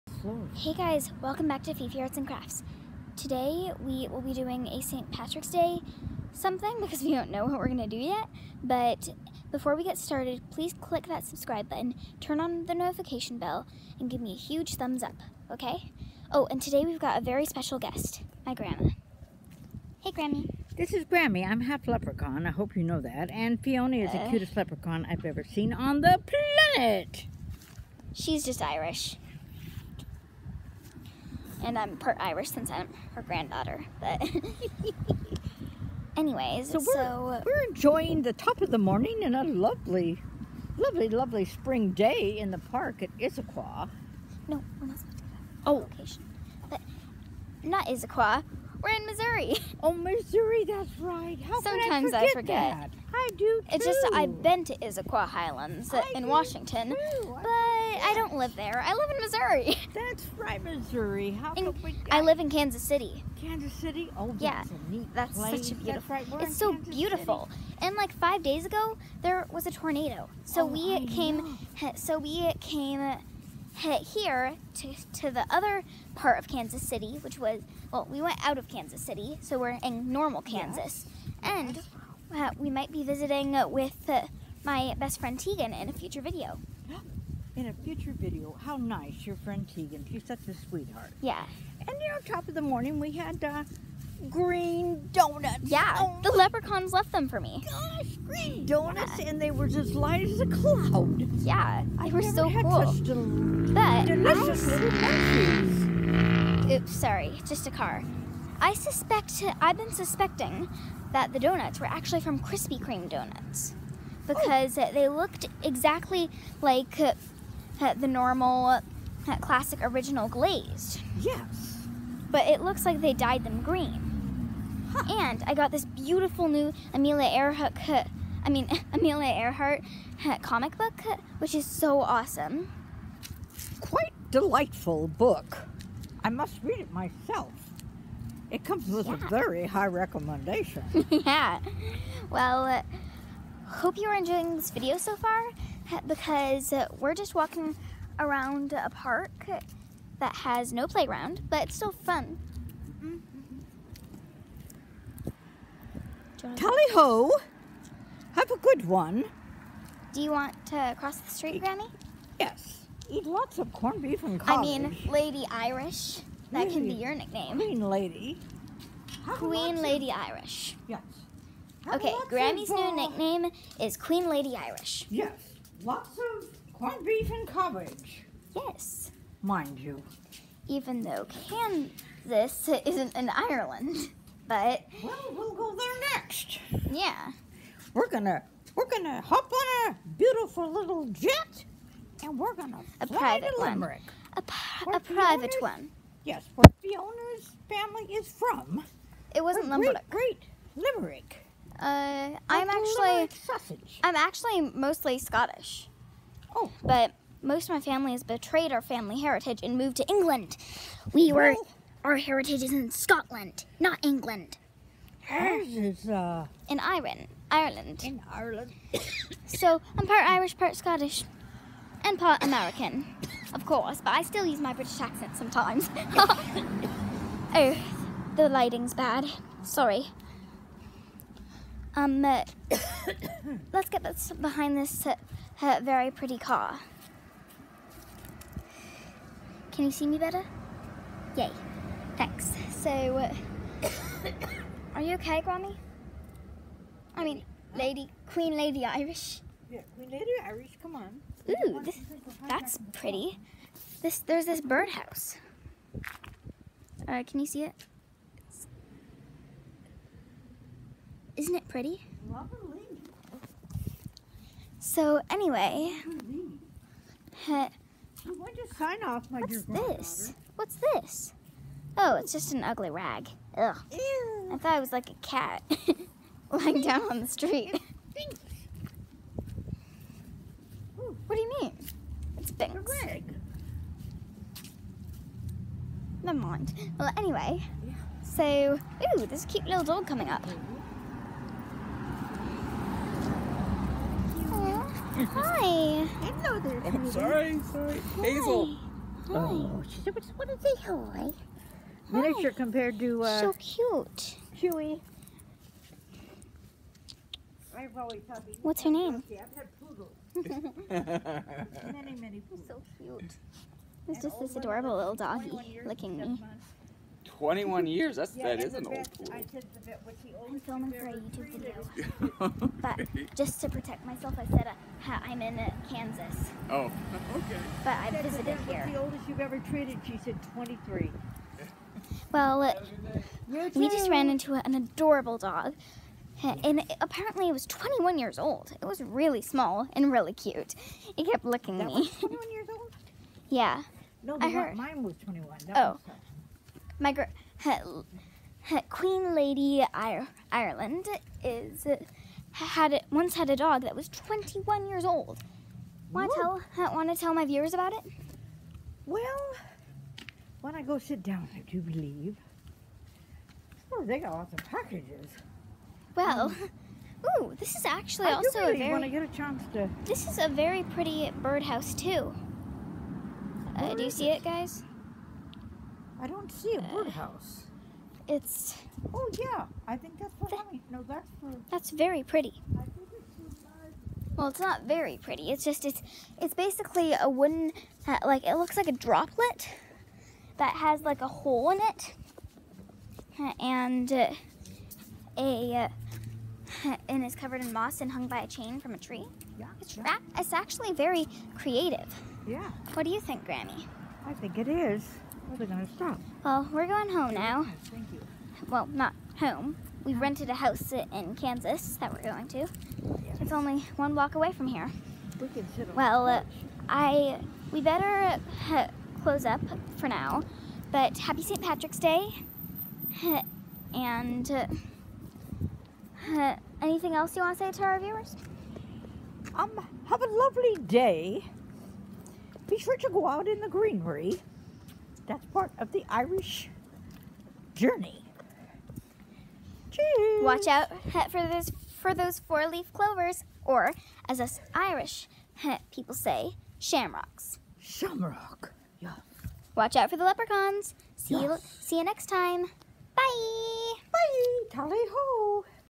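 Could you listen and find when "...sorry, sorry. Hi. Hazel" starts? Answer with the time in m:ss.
4:57.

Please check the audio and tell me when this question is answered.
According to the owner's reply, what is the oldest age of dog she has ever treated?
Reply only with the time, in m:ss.
5:30.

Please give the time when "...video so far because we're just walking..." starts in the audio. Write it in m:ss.
2:24.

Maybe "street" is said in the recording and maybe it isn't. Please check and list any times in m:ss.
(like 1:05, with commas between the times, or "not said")
2:41, 4:37.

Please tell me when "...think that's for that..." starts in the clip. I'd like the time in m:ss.
6:19.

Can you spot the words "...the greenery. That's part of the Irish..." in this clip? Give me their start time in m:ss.
7:13.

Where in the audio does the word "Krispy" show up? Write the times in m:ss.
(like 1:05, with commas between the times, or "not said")
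1:52.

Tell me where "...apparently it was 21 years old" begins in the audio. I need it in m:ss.
5:37.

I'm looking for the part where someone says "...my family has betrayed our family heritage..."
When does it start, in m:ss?
3:27.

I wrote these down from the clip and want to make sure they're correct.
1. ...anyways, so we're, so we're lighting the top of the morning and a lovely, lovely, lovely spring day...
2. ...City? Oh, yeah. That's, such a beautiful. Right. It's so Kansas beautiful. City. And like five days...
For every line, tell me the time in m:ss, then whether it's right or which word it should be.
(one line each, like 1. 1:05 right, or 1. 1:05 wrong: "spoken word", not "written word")
1. 0:36 wrong: "enjoying", not "lighting"
2. 1:03 right.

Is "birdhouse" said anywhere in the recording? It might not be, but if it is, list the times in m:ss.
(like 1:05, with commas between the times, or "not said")
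4:14, 6:11, 6:16.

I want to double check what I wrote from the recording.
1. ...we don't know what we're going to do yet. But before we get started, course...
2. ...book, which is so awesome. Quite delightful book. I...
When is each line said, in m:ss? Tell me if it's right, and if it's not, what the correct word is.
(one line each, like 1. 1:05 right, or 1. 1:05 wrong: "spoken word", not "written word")
1. 0:07 wrong: "please", not "course"
2. 2:10 right.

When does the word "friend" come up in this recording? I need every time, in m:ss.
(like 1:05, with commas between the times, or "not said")
1:25, 1:29.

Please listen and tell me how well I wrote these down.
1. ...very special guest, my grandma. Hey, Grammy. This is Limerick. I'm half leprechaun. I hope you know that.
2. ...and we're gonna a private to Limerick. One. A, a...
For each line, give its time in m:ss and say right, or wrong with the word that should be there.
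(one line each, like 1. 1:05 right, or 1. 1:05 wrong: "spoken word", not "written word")
1. 0:17 wrong: "Grammy", not "Limerick"
2. 3:12 right.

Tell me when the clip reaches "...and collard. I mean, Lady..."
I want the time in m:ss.
2:44.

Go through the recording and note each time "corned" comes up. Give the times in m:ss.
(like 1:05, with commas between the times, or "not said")
2:43, 2:56.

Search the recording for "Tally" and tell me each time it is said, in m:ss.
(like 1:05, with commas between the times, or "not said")
2:36, 7:34.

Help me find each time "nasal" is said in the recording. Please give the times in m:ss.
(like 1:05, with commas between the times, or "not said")
not said.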